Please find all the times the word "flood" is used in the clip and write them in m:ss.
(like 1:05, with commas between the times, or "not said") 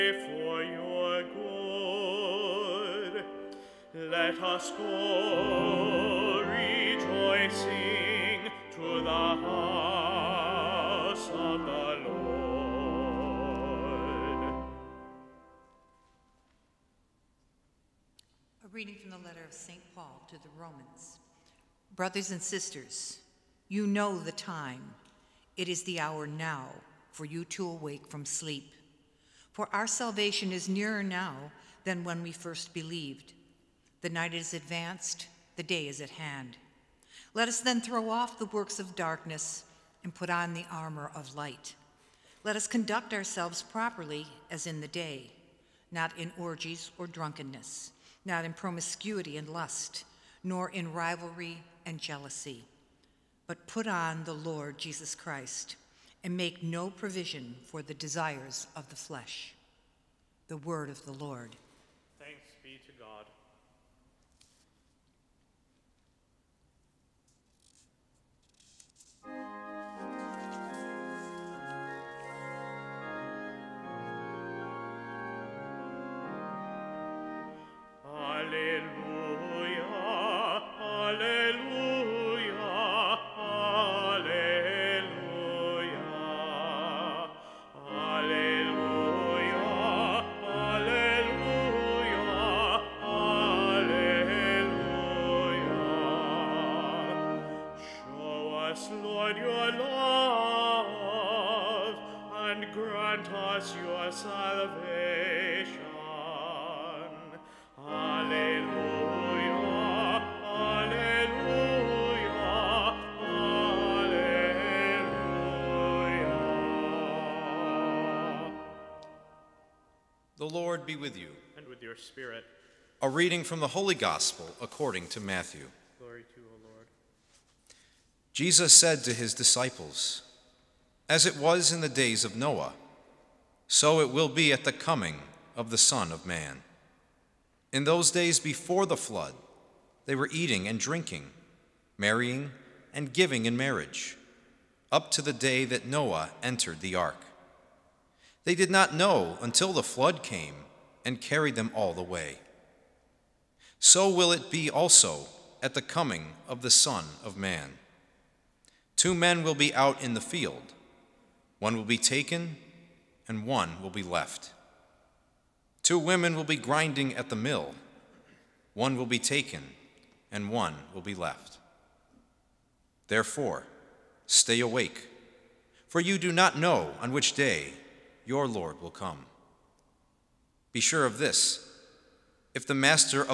2:18, 2:29.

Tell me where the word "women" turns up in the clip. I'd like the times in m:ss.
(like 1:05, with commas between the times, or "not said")
2:45.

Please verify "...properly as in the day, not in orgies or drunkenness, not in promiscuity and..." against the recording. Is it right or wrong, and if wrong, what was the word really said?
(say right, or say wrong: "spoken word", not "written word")
right.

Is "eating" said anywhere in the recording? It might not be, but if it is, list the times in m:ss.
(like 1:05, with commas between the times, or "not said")
2:20.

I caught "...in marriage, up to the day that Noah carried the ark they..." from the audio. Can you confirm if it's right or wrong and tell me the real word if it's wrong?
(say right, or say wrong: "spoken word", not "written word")
wrong: "entered", not "carried".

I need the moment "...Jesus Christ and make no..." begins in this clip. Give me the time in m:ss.
0:54.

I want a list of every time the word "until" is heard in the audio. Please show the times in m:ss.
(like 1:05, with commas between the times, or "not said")
2:29.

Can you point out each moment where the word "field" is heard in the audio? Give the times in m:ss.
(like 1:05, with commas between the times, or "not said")
2:40.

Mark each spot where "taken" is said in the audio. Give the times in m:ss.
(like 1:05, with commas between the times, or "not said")
2:41, 2:49.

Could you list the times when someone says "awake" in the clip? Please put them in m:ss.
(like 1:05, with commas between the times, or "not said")
0:27, 2:54.